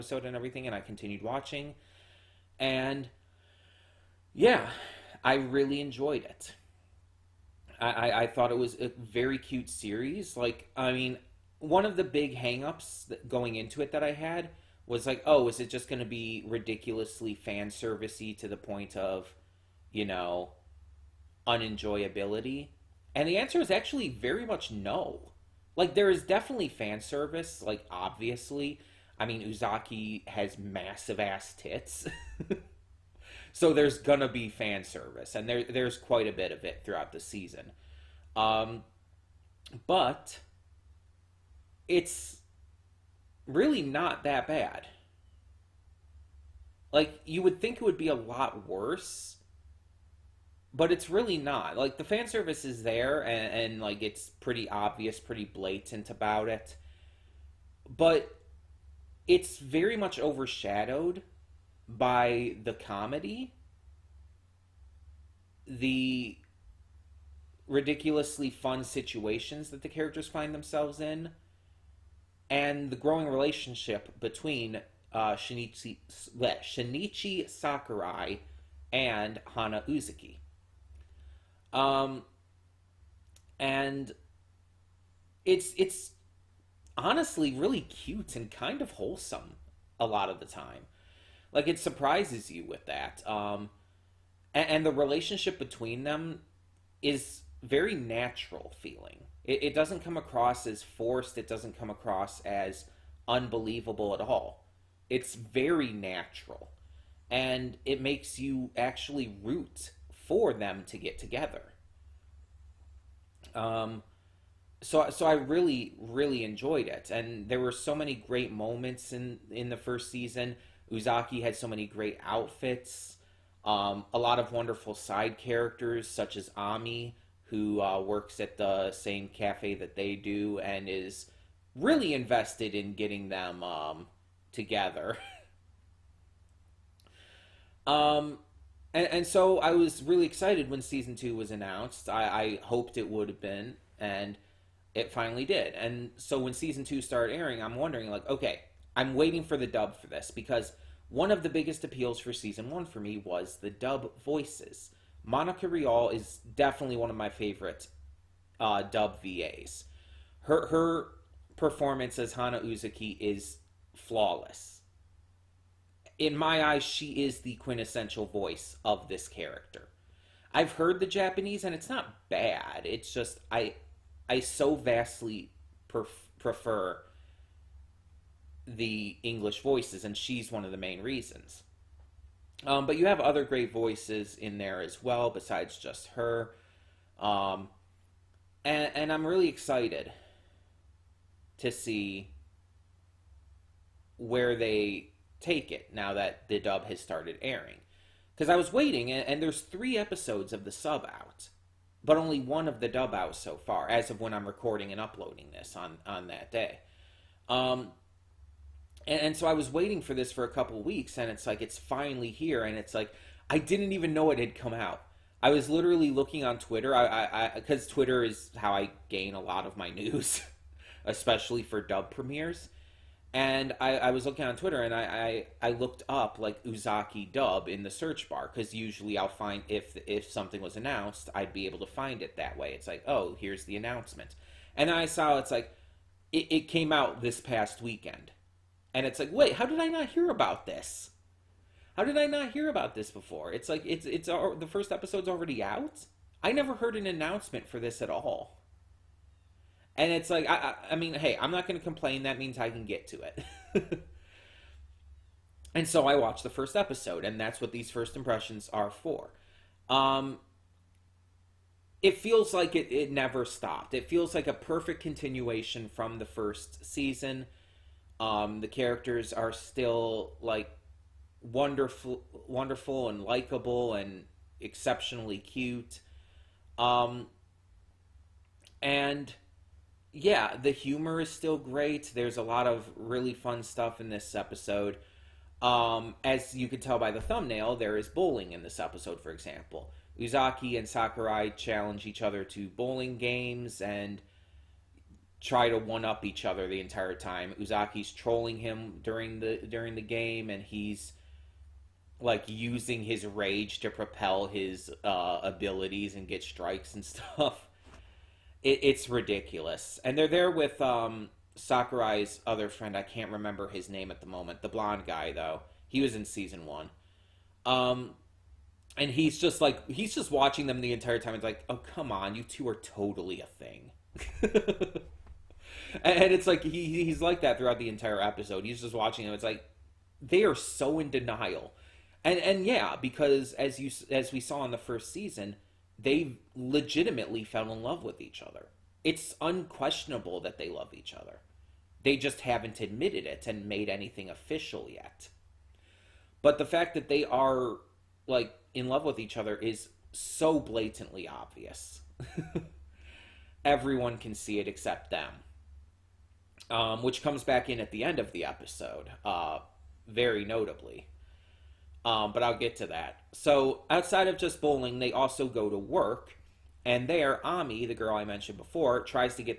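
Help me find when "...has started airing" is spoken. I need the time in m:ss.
3:16.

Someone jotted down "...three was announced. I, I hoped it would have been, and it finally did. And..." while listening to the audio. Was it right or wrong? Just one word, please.
wrong.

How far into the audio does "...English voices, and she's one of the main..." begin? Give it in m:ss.
2:59.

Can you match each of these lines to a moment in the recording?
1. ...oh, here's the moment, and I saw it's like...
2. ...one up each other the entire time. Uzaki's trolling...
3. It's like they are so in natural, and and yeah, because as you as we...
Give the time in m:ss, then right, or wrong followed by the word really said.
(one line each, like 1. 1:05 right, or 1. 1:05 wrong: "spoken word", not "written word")
1. 3:53 wrong: "announcement", not "moment"
2. 4:55 right
3. 5:29 wrong: "denial", not "natural".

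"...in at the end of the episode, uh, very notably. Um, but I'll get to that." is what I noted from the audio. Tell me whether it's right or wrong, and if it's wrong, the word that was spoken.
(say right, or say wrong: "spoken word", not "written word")
right.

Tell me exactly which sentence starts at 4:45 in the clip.
Um, as you can tell by the thumbnail, there is bowling in this episode, for example.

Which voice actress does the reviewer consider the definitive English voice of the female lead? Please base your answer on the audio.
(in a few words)
Monica Rial.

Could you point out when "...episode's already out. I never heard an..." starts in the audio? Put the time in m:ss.
4:04.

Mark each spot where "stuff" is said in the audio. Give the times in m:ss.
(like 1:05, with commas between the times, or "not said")
4:43, 5:07.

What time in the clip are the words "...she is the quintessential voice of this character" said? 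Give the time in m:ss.
2:46.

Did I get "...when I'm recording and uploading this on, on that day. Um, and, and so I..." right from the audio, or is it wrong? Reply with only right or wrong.
right.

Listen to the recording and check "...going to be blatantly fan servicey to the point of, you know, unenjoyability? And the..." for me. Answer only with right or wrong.
wrong.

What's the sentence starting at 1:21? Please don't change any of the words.
Um, and it's it's honestly really cute and kind of wholesome a lot of the time.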